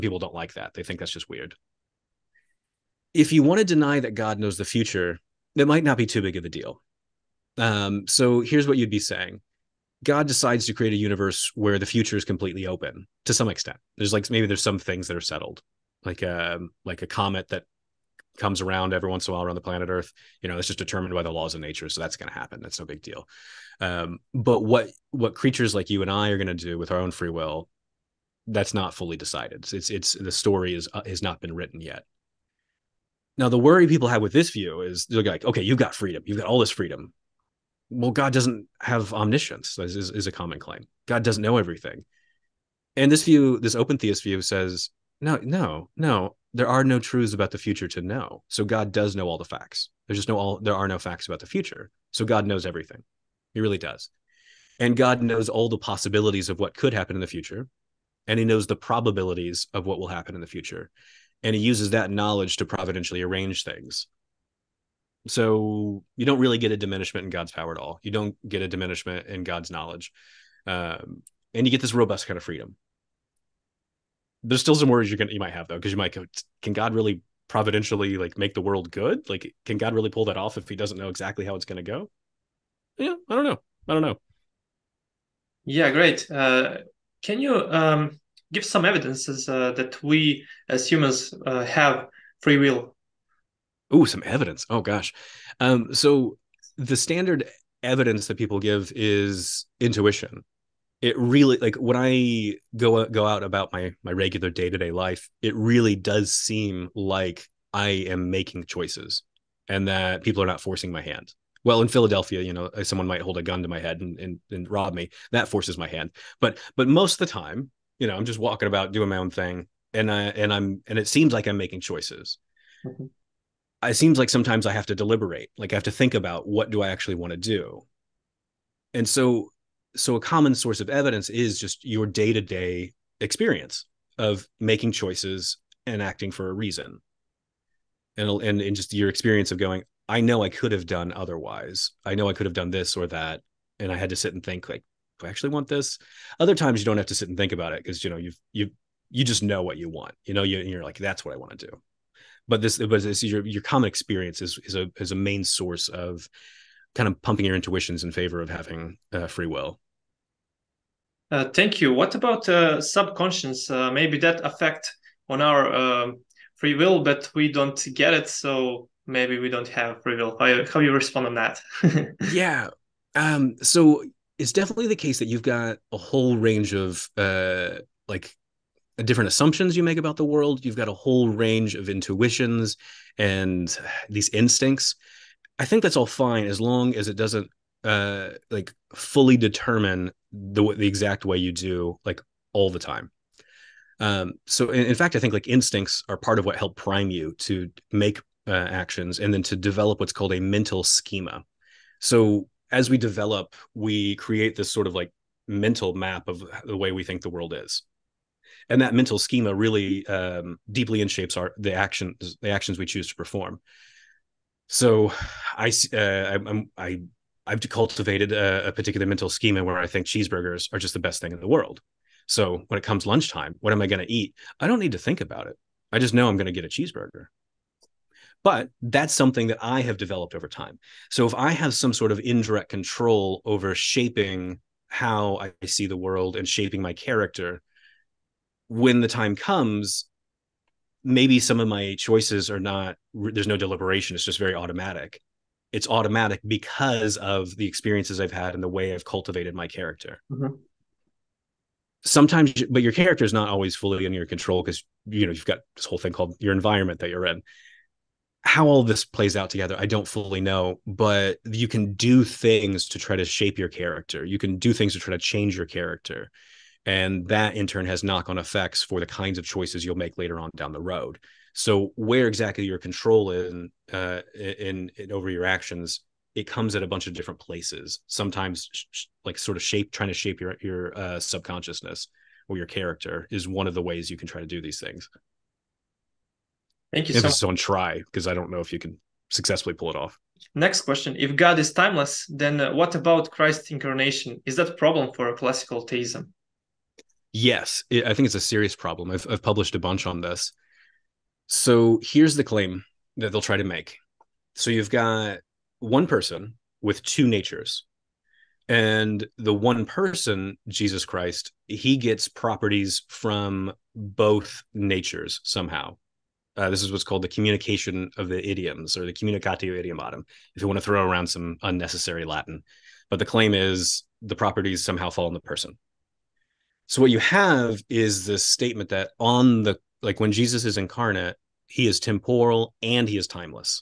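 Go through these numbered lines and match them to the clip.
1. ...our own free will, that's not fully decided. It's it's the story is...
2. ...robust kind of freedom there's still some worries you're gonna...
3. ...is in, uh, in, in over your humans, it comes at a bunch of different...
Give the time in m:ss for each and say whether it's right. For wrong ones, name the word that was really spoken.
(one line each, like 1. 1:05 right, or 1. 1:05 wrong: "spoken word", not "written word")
1. 0:26 right
2. 1:11 right
3. 4:33 wrong: "actions", not "humans".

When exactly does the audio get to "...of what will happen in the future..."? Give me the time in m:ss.
0:59.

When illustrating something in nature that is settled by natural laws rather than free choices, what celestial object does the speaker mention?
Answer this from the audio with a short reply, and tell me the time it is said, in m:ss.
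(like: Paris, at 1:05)
comet, at 0:17.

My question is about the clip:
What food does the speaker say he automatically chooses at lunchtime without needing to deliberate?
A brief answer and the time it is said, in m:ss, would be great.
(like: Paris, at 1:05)
cheeseburger, at 3:46.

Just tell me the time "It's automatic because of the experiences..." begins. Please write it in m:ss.
4:05.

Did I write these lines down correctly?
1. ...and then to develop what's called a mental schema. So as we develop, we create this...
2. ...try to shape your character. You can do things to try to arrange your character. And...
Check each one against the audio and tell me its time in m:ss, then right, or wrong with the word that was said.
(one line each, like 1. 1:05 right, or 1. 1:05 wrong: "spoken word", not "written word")
1. 3:19 right
2. 4:22 wrong: "change", not "arrange".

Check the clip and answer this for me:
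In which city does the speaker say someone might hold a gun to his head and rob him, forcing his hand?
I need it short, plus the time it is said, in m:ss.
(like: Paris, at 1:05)
Philadelphia, at 1:51.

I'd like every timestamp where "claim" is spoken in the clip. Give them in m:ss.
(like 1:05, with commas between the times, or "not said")
0:40, 5:02, 5:23.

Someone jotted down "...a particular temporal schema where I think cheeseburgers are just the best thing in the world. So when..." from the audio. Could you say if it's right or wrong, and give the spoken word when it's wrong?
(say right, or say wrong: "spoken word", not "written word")
wrong: "mental", not "temporal".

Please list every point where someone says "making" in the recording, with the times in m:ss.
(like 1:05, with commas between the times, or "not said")
1:48, 2:01, 2:14.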